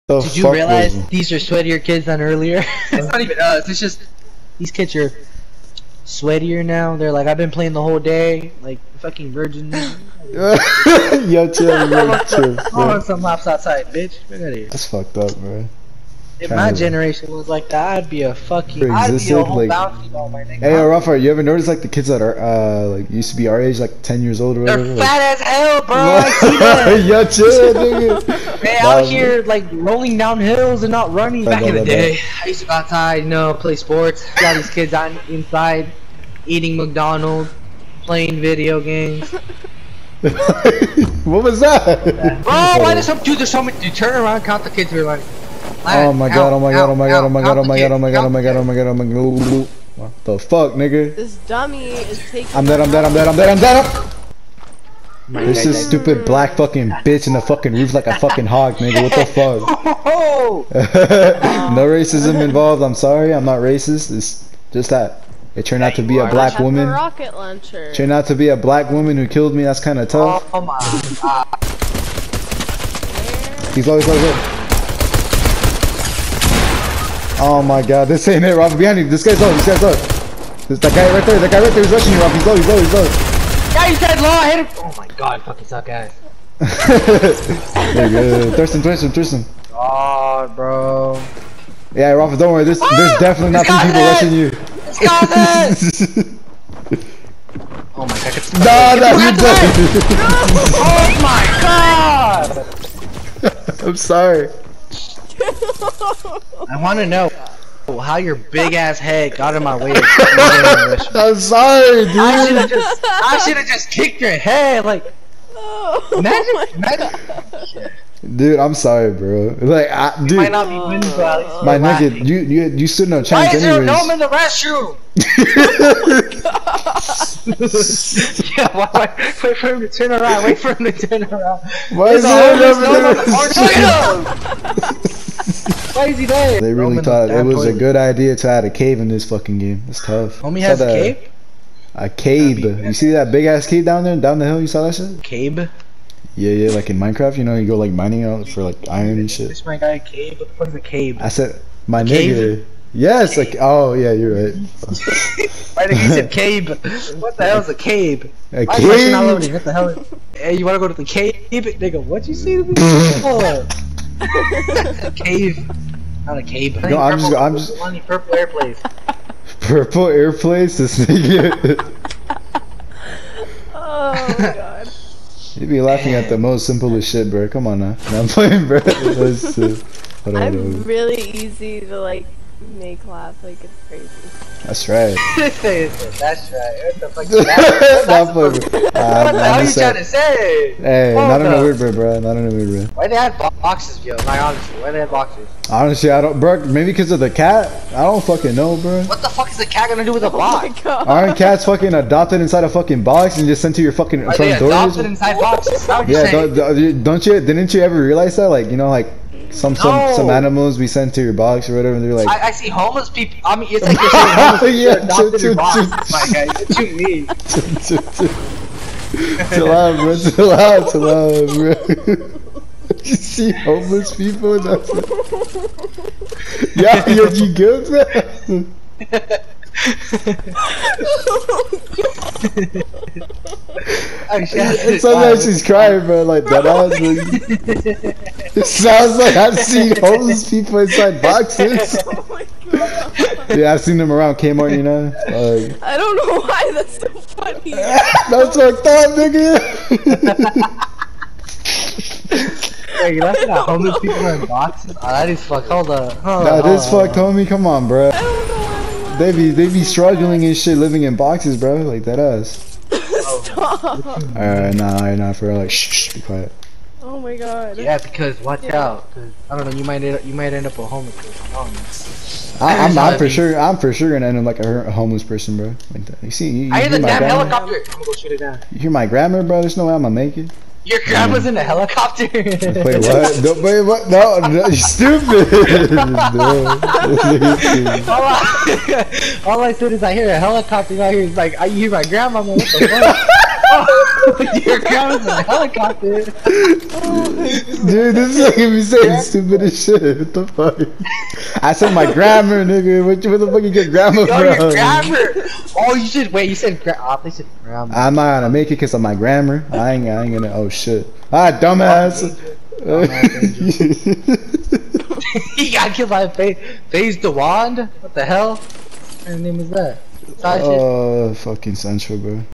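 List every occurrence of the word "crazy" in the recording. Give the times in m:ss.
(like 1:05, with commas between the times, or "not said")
2:15, 3:03.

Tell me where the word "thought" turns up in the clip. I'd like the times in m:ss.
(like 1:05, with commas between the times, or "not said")
2:17, 4:08.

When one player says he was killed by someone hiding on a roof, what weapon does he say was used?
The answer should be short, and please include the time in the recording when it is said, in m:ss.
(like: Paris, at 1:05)
Rocket launcher, at 1:06.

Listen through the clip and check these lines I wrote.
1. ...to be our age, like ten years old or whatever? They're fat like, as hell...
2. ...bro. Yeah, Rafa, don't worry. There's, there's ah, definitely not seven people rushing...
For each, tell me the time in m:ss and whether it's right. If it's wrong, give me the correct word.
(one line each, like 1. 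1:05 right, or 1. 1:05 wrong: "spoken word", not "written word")
1. 0:23 right
2. 1:30 wrong: "three", not "seven".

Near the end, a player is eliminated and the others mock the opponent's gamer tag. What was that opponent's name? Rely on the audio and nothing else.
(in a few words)
Faze the Wand.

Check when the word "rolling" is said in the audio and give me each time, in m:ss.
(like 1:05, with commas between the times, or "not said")
0:29.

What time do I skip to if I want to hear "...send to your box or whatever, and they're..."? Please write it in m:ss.
3:30.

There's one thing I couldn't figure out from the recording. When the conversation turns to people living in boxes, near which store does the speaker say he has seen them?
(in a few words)
Kmart.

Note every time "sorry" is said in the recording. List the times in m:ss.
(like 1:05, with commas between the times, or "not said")
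1:02, 1:43, 1:51, 1:58.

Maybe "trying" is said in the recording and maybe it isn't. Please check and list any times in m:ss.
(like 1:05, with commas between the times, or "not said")
3:09.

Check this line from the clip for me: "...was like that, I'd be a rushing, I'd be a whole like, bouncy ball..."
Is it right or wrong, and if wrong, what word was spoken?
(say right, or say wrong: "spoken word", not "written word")
wrong: "fucking", not "rushing".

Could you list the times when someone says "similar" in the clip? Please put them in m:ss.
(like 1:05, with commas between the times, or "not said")
not said.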